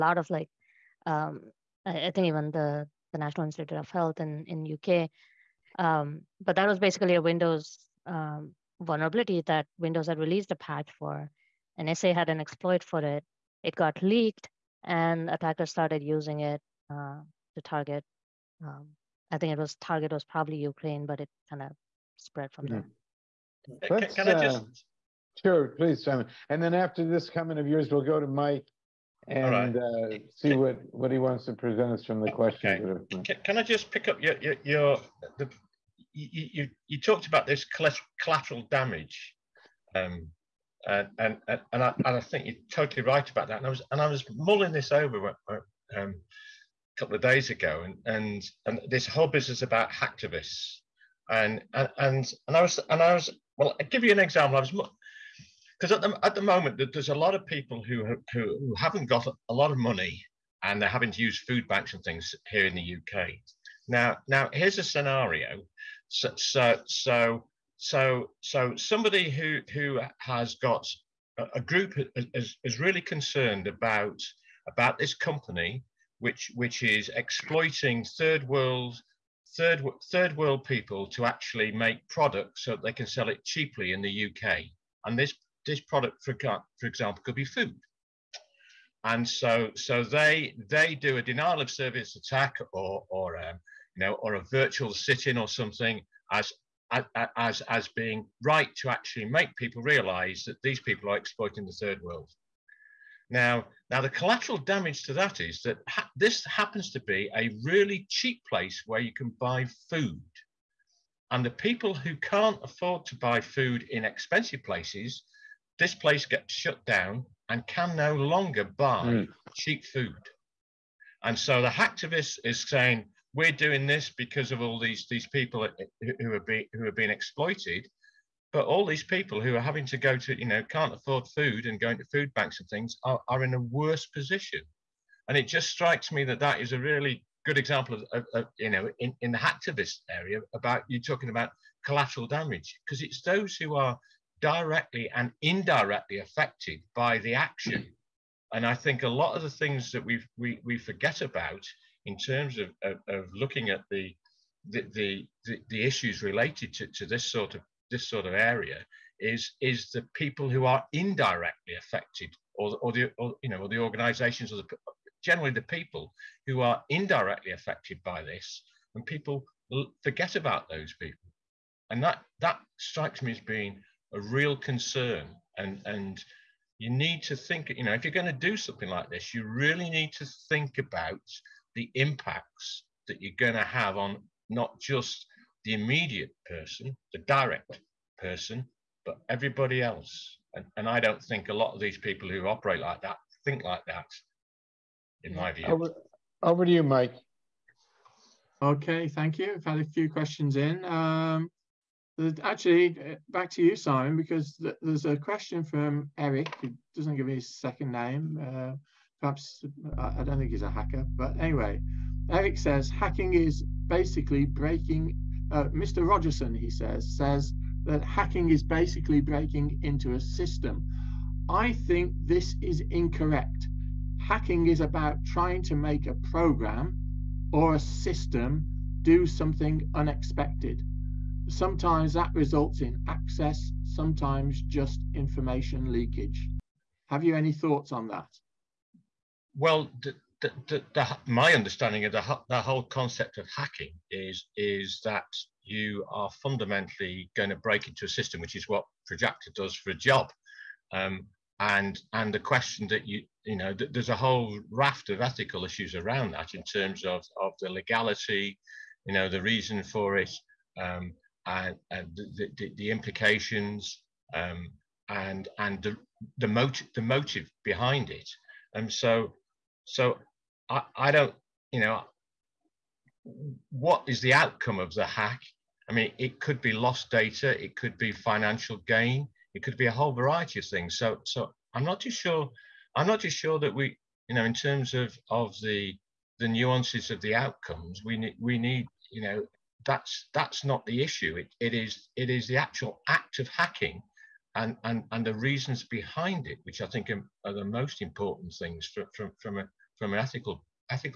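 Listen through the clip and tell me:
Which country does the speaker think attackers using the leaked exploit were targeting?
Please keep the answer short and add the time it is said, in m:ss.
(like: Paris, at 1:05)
Ukraine, at 0:20.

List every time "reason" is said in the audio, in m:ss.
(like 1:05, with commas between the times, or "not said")
4:19, 4:55.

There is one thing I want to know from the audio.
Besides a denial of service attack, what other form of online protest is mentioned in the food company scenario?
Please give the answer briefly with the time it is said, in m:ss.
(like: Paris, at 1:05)
Virtual sit-in, at 1:34.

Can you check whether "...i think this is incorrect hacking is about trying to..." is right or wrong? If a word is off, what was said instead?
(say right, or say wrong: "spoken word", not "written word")
right.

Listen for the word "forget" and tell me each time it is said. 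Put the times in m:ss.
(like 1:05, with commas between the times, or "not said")
2:30, 2:50.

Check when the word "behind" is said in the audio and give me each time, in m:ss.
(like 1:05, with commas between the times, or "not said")
4:27, 4:55.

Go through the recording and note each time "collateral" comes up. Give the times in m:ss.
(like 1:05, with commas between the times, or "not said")
0:38, 1:44, 2:21.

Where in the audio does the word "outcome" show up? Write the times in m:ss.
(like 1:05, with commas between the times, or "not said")
4:34, 4:47.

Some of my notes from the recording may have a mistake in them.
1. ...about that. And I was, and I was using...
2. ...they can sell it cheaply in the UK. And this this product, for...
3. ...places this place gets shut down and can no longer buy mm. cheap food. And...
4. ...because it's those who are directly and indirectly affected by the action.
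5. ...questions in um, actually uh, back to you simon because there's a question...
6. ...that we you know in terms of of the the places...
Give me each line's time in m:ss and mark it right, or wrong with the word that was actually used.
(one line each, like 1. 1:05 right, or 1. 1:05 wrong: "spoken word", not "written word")
1. 0:43 wrong: "mulling", not "using"
2. 1:22 right
3. 1:54 right
4. 2:22 right
5. 3:20 right
6. 4:43 wrong: "nuances", not "places".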